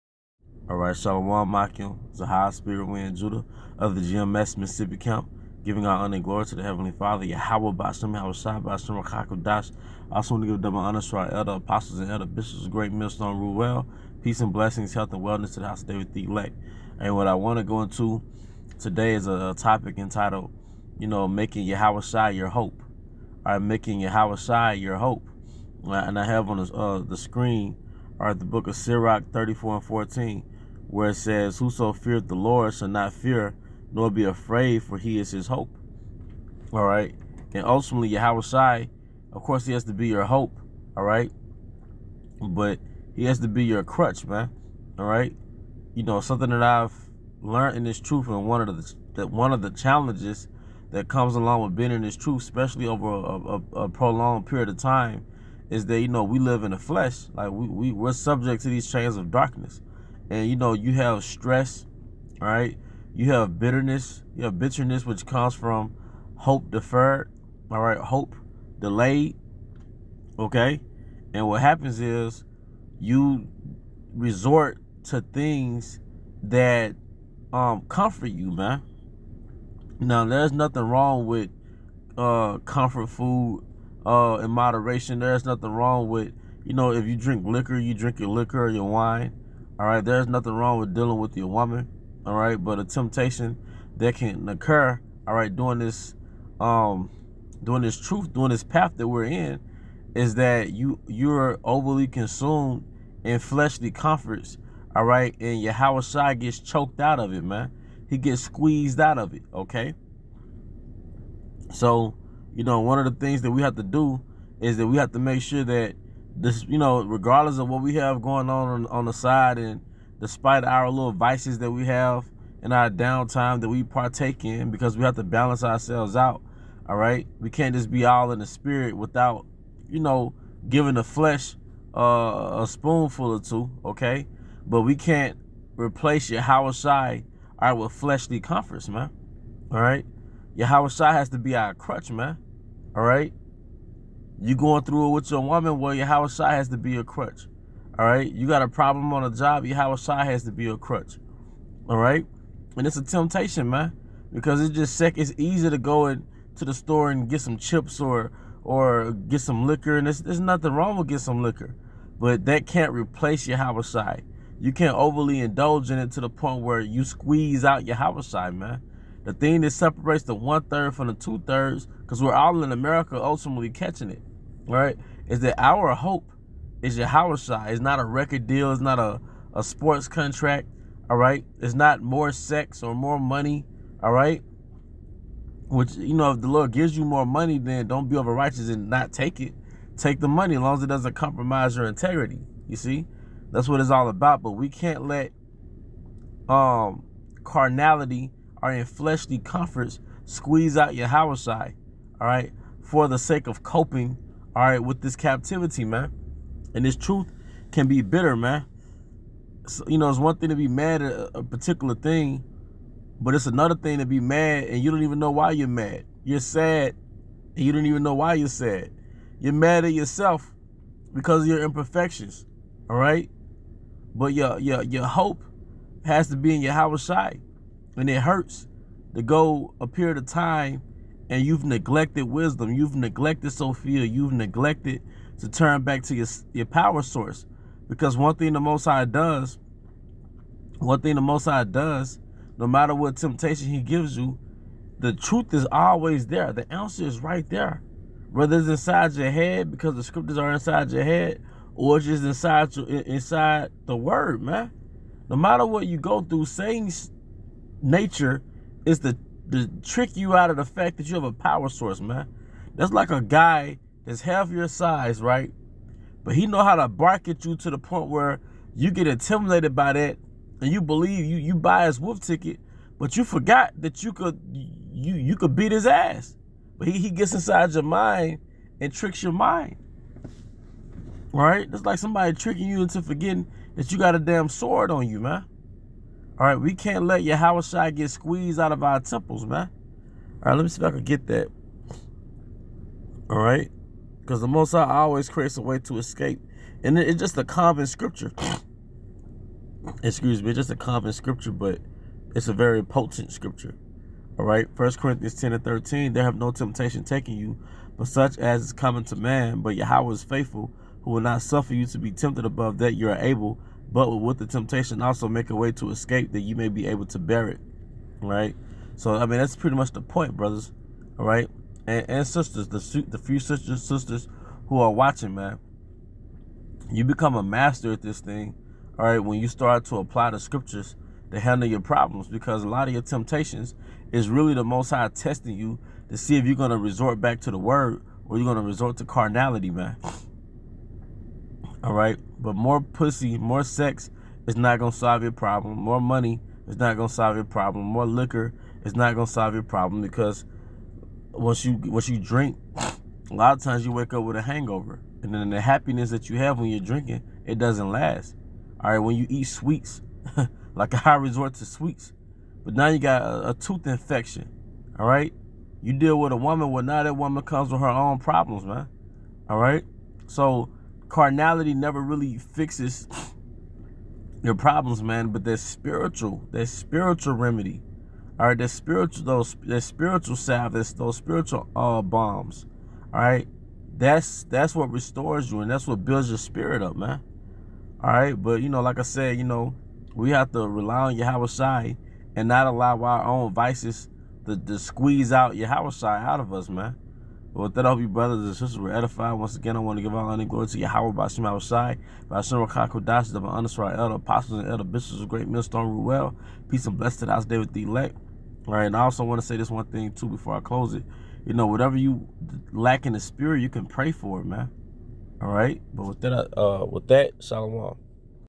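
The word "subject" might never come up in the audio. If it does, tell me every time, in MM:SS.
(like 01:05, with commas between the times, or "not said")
00:58.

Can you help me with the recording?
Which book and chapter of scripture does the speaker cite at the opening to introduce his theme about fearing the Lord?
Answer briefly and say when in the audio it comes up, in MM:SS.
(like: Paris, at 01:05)
Sirach 34, at 00:28.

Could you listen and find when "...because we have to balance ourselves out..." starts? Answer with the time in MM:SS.
02:04.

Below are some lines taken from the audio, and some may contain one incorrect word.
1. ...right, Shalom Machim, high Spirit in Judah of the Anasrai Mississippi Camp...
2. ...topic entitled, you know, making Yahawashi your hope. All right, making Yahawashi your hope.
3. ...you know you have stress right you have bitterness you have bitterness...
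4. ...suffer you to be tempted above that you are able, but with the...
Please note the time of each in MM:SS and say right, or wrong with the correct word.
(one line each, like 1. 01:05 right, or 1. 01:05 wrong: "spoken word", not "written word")
1. 00:00 wrong: "GMS", not "Anasrai"
2. 00:19 right
3. 01:00 right
4. 05:11 right.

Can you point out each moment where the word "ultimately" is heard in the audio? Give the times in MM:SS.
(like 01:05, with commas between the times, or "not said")
00:37, 02:53.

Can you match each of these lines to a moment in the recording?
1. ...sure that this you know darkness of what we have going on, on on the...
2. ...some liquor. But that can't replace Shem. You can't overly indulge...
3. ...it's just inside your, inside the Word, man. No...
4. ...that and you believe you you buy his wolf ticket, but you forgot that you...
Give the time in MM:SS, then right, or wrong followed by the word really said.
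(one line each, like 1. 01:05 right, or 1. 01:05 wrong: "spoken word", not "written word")
1. 01:55 wrong: "regardless", not "darkness"
2. 02:41 wrong: "Yahawashi", not "Shem"
3. 04:11 right
4. 04:29 right.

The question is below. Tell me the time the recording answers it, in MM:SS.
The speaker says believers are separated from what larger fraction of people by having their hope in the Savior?
02:51.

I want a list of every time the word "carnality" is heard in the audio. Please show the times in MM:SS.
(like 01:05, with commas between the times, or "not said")
03:17, 05:39, 06:11.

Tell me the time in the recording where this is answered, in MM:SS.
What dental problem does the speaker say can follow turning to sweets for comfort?
06:03.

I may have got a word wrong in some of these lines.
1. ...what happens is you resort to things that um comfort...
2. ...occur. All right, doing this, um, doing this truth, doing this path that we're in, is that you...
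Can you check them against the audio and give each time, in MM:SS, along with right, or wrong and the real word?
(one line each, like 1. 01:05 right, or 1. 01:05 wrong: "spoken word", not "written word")
1. 01:11 right
2. 01:34 right.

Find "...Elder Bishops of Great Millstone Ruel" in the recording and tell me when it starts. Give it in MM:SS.
06:44.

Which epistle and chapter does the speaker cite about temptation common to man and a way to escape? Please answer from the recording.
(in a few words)
First Corinthians 10.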